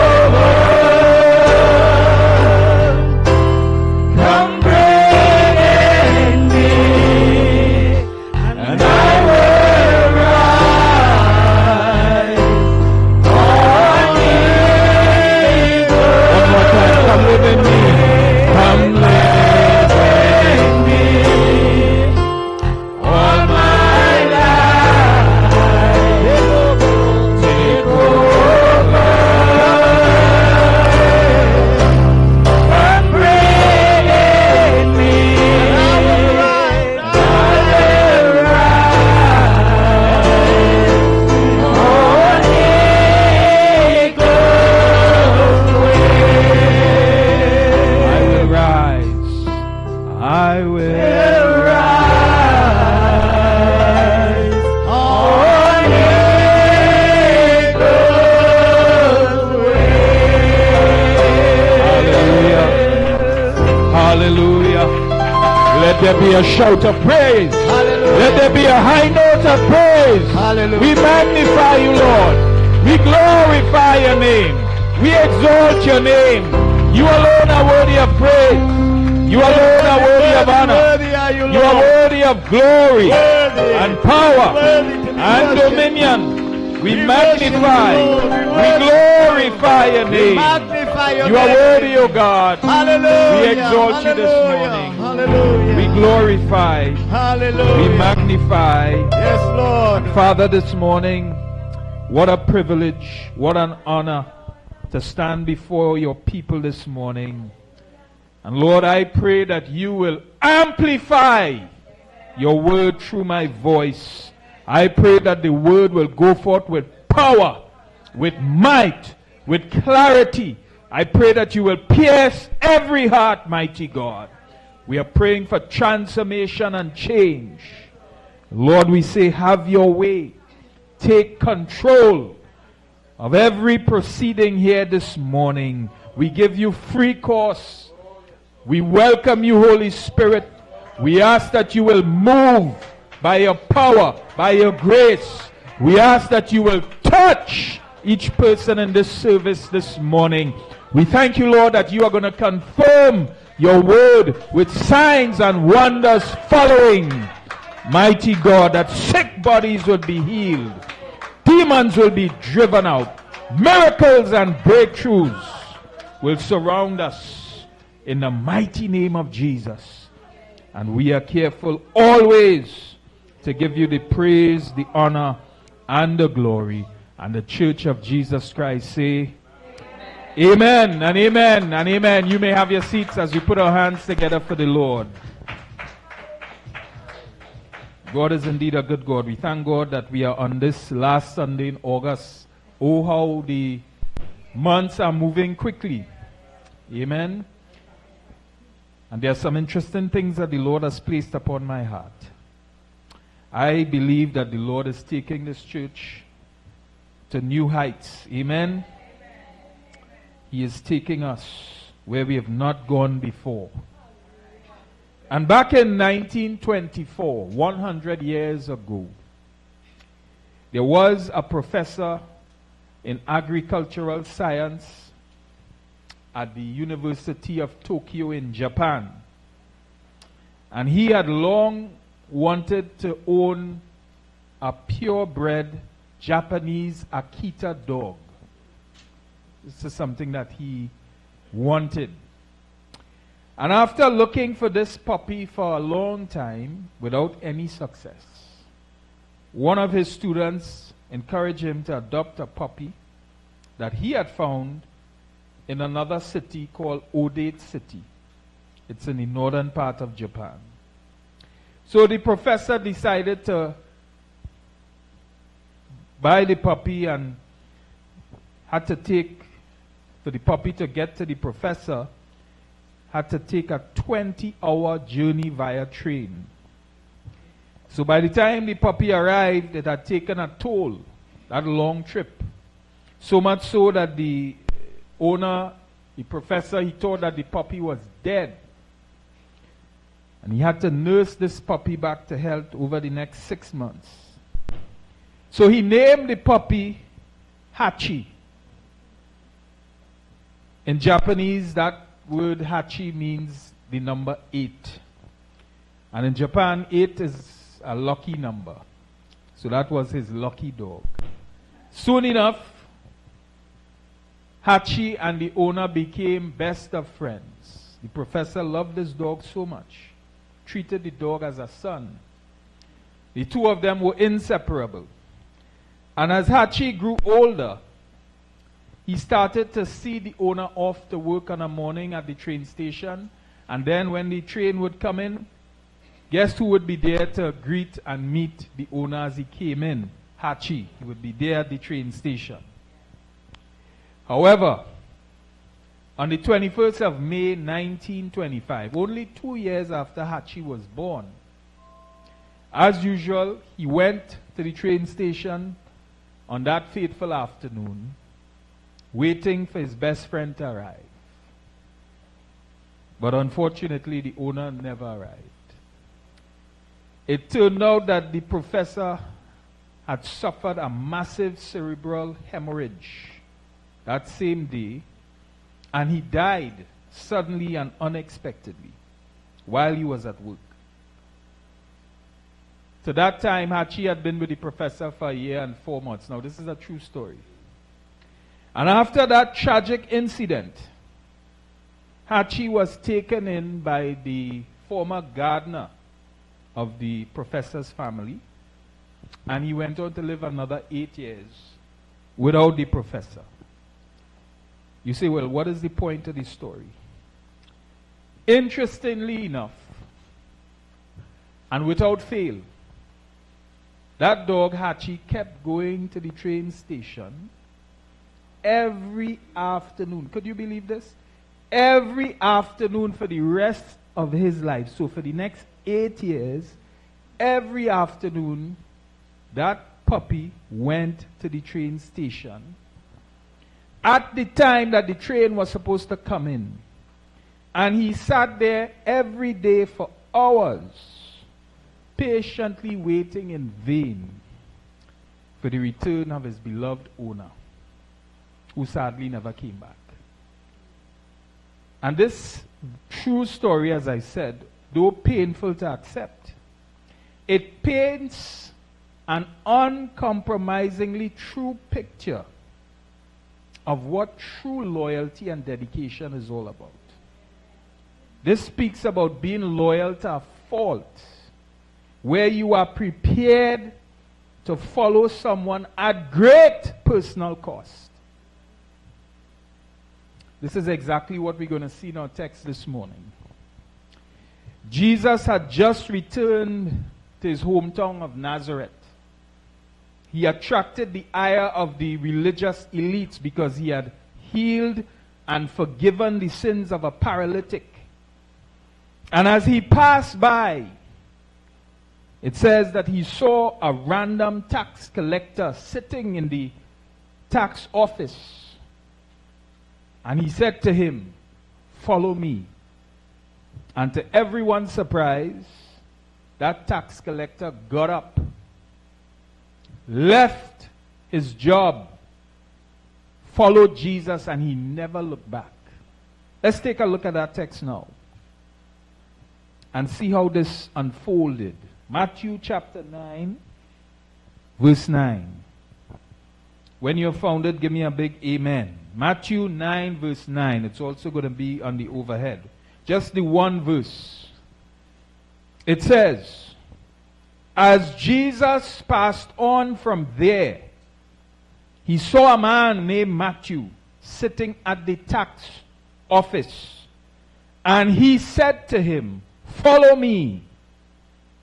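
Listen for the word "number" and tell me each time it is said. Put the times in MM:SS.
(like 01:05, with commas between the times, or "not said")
05:03, 05:08.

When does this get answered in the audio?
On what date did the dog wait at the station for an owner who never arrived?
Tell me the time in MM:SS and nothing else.
05:46.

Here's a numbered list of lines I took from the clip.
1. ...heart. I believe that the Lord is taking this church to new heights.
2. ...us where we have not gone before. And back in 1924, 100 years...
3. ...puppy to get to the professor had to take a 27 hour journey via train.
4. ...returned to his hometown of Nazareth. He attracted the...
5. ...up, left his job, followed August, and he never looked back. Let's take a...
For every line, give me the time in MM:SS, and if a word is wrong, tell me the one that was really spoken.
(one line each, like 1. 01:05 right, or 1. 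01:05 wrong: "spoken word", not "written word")
1. 03:21 right
2. 03:31 right
3. 04:30 wrong: "20", not "27"
4. 08:06 right
5. 08:38 wrong: "Jesus", not "August".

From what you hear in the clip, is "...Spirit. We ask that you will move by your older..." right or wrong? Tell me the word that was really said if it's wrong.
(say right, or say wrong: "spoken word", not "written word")
wrong: "power", not "older".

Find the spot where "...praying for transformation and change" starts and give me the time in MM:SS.
02:05.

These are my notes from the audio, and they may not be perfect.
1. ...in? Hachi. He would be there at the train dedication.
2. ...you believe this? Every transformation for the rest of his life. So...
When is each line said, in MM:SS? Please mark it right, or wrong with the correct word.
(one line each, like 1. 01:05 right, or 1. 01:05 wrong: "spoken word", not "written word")
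1. 05:39 wrong: "station", not "dedication"
2. 07:00 wrong: "afternoon", not "transformation".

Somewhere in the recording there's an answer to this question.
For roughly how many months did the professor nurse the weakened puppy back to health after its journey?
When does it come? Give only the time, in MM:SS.
04:53.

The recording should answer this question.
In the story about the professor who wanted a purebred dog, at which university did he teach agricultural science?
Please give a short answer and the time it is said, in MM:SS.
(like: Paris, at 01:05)
University of Tokyo, at 03:46.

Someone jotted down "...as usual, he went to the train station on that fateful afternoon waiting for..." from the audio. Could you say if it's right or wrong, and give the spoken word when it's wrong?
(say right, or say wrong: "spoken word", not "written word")
right.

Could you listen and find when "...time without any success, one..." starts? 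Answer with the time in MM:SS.
04:06.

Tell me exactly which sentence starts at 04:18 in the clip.
It's in the northern part of Japan.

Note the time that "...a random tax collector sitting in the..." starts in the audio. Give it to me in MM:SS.
08:23.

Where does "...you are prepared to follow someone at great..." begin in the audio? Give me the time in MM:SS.
07:52.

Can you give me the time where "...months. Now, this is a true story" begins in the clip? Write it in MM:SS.
06:25.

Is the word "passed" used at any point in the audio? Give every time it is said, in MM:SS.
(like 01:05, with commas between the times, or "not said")
08:19, 09:09.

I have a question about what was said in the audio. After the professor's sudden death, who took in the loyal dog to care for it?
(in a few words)
The former gardener.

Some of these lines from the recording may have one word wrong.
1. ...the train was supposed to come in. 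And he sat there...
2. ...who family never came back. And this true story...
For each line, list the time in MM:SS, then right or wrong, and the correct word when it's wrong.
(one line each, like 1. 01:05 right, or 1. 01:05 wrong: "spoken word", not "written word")
1. 07:15 right
2. 07:28 wrong: "sadly", not "family".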